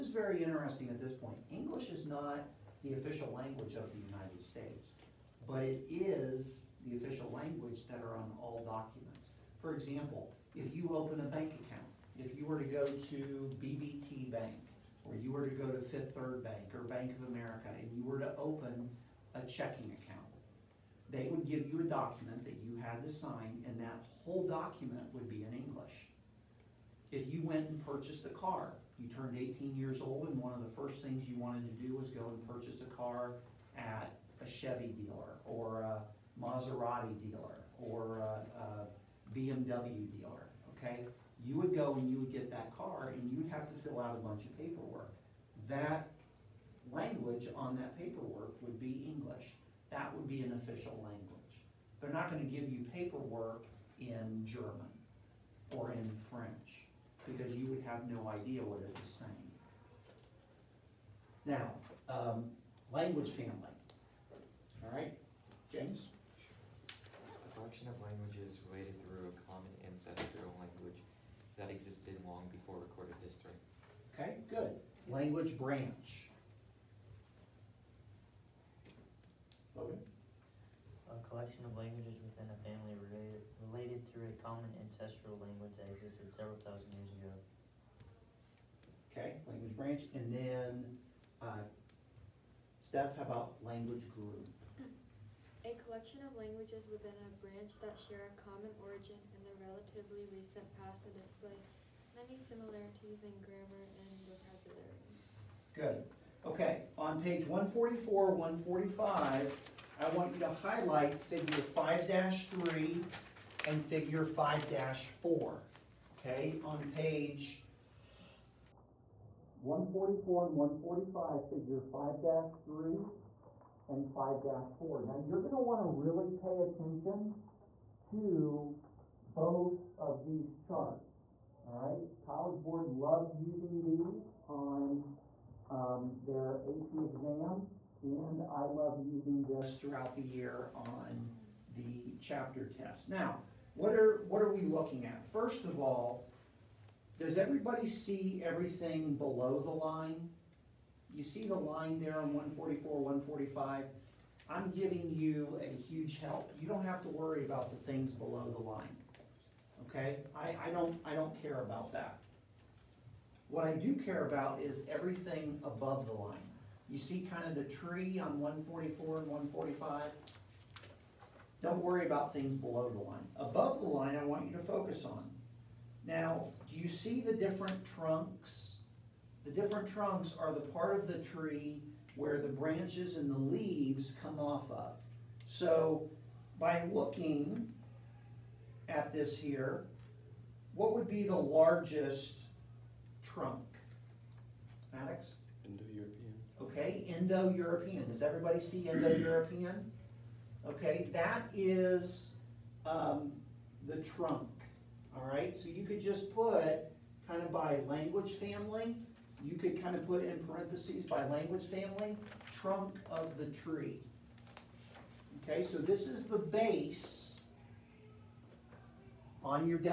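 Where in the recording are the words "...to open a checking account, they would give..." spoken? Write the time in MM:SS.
00:18.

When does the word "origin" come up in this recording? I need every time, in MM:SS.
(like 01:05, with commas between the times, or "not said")
01:38.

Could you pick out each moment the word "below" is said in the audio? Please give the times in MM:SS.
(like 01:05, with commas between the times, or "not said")
02:29, 02:38, 02:52.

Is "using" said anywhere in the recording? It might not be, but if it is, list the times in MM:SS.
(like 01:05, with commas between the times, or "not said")
02:13, 02:19.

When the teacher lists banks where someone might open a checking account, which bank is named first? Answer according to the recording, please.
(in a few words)
BBT Bank.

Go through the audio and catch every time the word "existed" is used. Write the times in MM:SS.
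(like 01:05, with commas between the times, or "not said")
01:11, 01:25.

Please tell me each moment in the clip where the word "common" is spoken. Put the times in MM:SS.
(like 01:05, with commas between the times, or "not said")
01:24, 01:38.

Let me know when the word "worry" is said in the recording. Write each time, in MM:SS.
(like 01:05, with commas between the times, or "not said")
02:37, 02:51.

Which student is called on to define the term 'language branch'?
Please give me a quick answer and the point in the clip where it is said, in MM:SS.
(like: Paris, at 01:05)
Logan, at 01:19.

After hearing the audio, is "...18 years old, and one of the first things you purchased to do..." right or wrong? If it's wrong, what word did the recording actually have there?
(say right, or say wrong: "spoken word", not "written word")
wrong: "wanted", not "purchased".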